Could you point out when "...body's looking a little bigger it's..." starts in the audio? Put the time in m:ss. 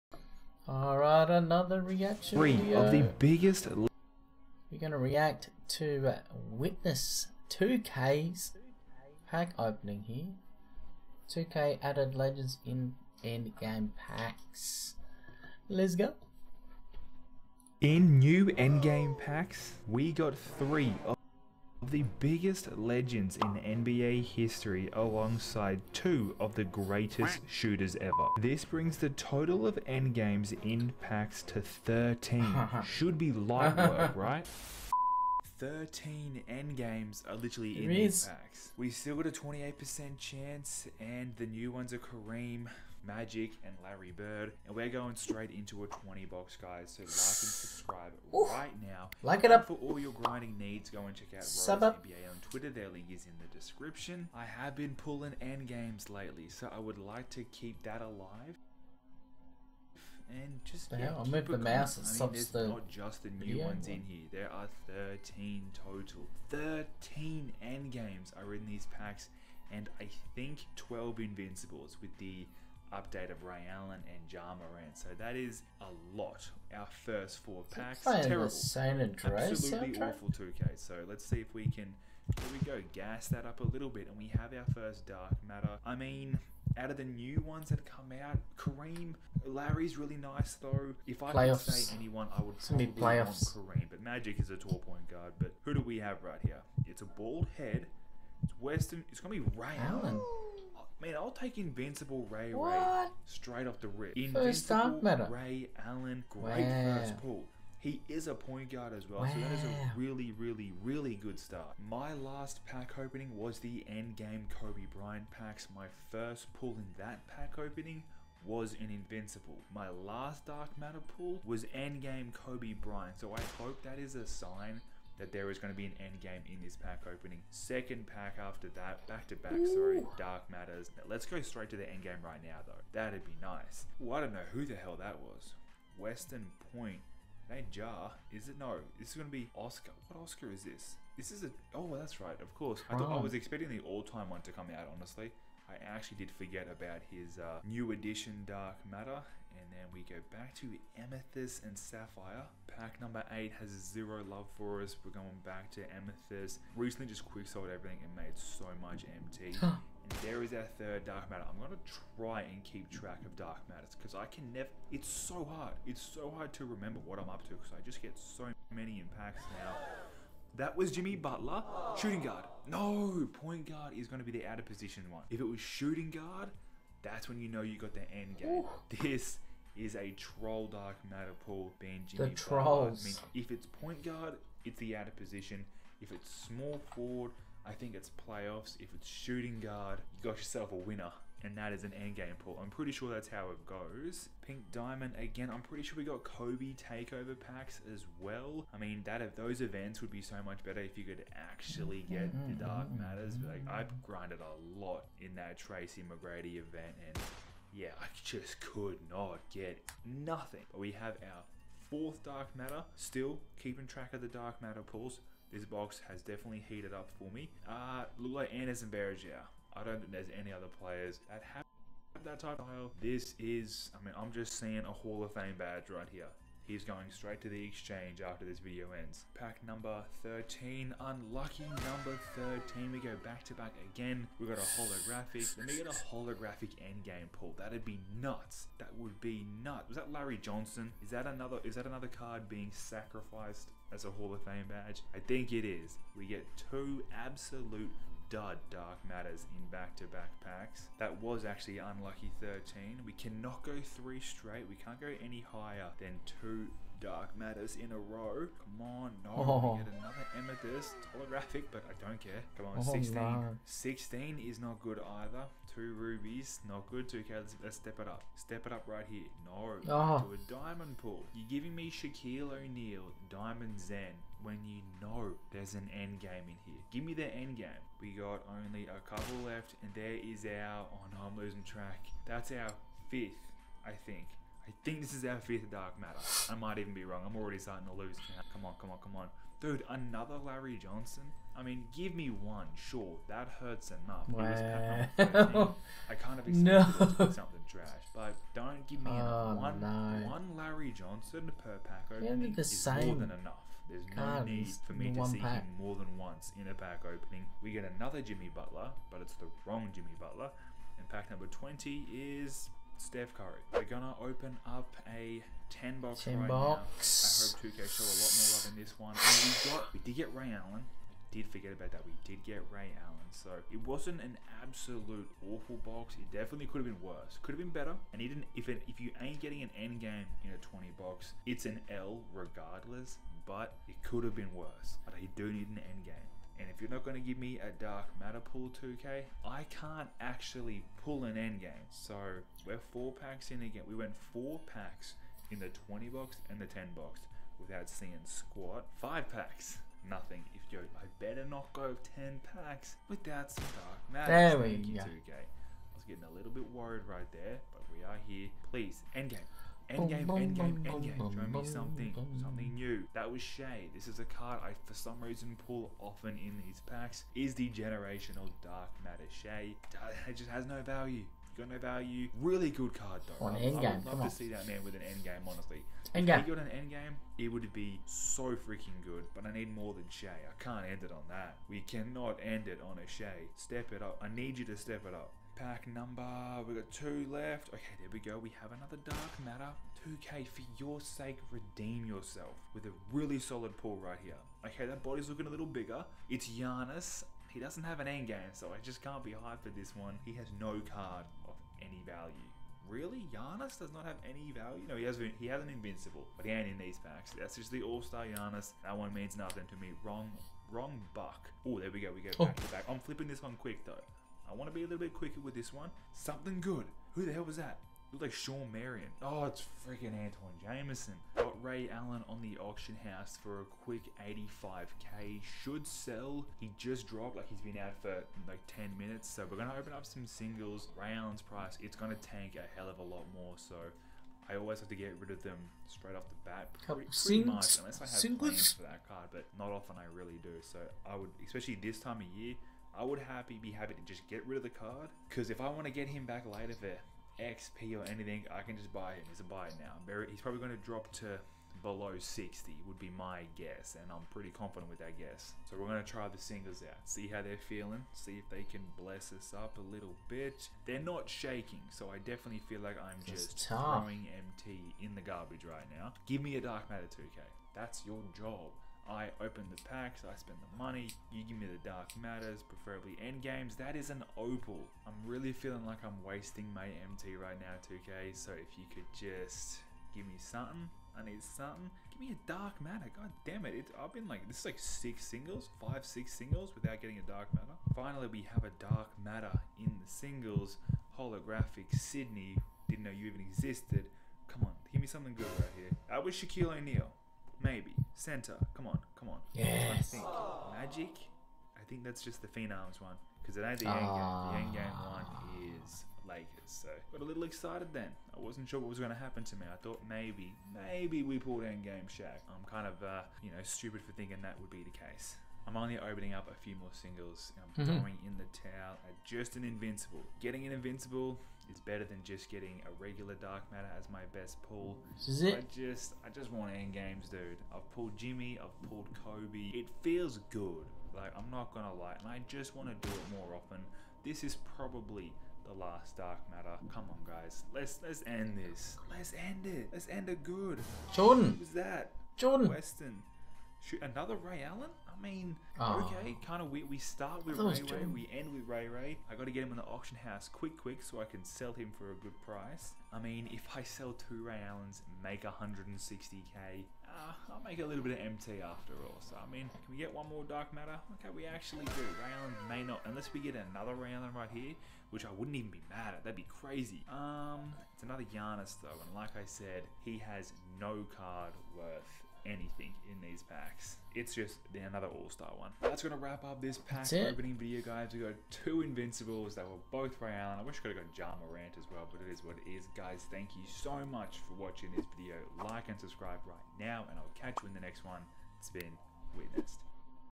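6:35.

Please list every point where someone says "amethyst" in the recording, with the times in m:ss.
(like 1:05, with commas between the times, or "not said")
2:30, 2:35, 4:20.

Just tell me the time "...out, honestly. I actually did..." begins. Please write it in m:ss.
2:24.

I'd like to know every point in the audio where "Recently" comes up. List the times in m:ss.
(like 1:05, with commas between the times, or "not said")
2:36.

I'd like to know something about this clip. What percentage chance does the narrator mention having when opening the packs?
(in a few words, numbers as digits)
28%.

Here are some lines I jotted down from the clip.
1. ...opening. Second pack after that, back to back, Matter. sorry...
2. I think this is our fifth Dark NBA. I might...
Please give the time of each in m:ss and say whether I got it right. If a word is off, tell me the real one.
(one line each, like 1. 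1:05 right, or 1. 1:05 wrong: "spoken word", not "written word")
1. 2:07 wrong: "Ooh", not "Matter"
2. 4:44 wrong: "Matter", not "NBA".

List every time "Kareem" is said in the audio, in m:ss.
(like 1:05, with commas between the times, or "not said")
0:41, 1:28, 1:33.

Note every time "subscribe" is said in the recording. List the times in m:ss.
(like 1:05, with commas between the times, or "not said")
0:47, 9:45.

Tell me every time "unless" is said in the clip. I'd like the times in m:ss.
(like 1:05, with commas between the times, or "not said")
7:17, 9:23.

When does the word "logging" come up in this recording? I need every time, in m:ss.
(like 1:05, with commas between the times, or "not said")
not said.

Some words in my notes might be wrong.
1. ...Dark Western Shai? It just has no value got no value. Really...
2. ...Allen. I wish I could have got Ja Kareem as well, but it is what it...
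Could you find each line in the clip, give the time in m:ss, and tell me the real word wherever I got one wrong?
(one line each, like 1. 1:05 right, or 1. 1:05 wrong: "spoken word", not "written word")
1. 6:08 wrong: "Matter", not "Western"
2. 9:40 wrong: "Morant", not "Kareem".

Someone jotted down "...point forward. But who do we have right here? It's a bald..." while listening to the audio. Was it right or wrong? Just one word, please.
wrong.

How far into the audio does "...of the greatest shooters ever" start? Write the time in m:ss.
0:26.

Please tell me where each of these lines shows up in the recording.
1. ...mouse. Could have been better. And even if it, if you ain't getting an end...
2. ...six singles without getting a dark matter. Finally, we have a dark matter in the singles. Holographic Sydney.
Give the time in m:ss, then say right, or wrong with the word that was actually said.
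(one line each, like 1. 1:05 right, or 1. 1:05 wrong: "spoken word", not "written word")
1. 5:27 wrong: "worse", not "mouse"
2. 8:06 right.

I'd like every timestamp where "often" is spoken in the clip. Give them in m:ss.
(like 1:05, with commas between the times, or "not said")
6:05, 7:19, 8:53.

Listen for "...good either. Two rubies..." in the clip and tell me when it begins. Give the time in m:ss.
4:24.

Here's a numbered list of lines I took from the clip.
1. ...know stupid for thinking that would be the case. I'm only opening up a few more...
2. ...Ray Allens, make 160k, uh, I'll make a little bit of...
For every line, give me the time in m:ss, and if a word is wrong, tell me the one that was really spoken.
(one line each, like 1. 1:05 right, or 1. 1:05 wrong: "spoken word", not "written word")
1. 8:33 right
2. 9:14 right.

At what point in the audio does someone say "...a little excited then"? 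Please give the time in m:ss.
8:27.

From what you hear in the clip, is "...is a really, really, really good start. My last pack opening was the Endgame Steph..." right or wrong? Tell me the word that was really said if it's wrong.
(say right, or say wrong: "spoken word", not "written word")
wrong: "Kobe", not "Steph".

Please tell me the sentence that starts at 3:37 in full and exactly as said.
Uh, look like Anderson Berger I don't think there's any other players that have that type of style.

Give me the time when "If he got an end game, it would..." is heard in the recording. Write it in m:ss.
6:16.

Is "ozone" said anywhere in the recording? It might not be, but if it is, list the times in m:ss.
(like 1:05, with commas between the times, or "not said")
not said.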